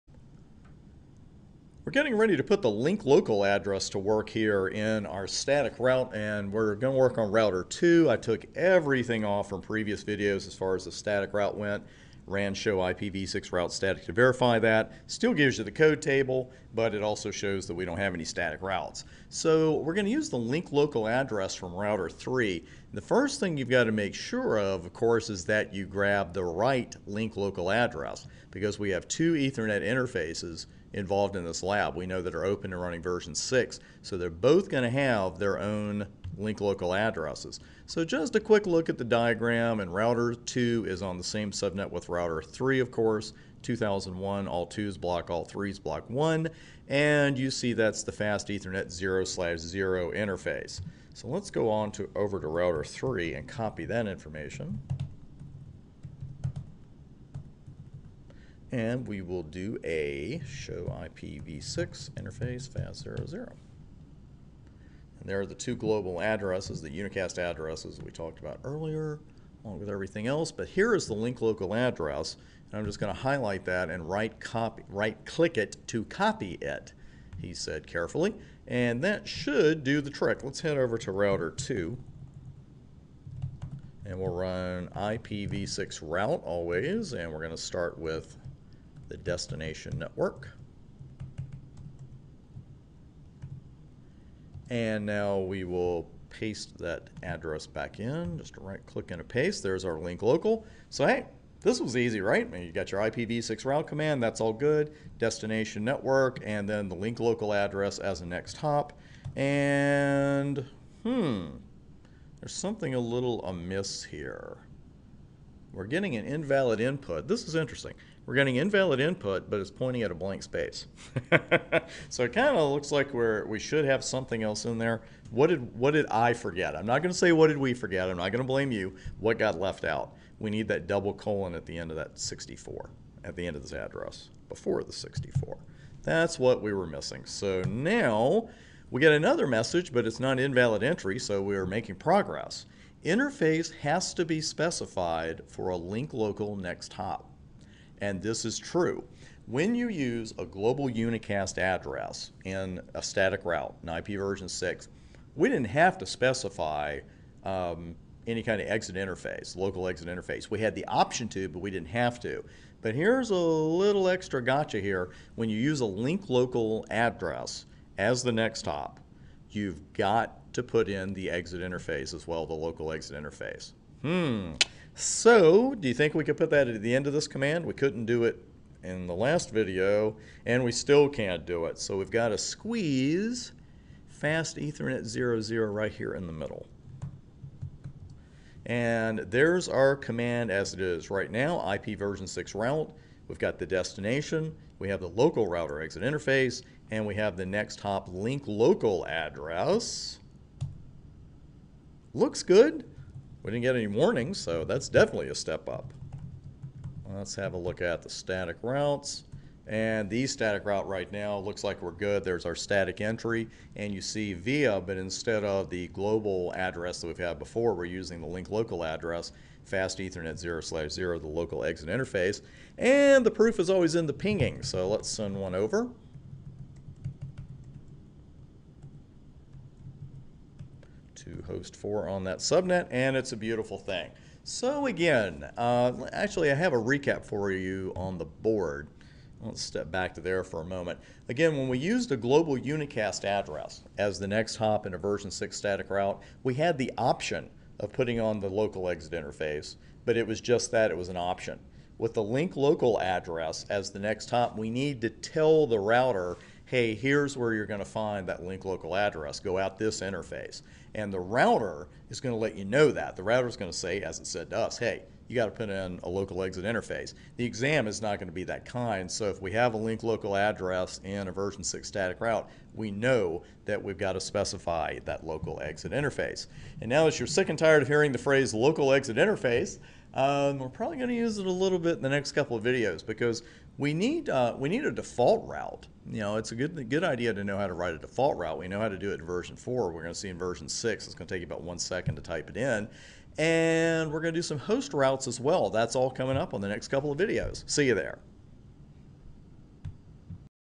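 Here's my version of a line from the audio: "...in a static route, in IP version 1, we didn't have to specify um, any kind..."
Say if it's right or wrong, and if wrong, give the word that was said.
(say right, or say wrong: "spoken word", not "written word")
wrong: "6", not "1".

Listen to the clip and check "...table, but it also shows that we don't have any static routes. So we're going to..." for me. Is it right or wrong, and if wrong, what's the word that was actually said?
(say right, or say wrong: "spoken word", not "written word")
right.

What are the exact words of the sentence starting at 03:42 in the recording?
And the proof is always in the pinging, so let's send one over.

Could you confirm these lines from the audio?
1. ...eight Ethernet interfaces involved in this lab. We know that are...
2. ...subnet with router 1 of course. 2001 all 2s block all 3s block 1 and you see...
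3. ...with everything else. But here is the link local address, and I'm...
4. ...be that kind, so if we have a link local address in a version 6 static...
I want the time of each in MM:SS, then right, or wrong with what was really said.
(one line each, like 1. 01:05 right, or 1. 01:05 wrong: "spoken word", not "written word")
1. 00:29 wrong: "two", not "eight"
2. 00:41 wrong: "3", not "1"
3. 01:09 right
4. 04:28 right.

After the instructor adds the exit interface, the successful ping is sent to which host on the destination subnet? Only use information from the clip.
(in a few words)
host 4.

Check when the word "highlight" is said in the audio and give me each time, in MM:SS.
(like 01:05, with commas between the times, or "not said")
01:13.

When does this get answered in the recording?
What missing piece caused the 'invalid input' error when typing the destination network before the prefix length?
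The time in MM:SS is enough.
02:10.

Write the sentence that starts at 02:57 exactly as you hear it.
We couldn't do it in the last video, and we still can't do it.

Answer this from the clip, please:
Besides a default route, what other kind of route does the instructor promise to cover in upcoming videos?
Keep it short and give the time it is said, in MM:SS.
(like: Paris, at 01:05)
host routes, at 04:54.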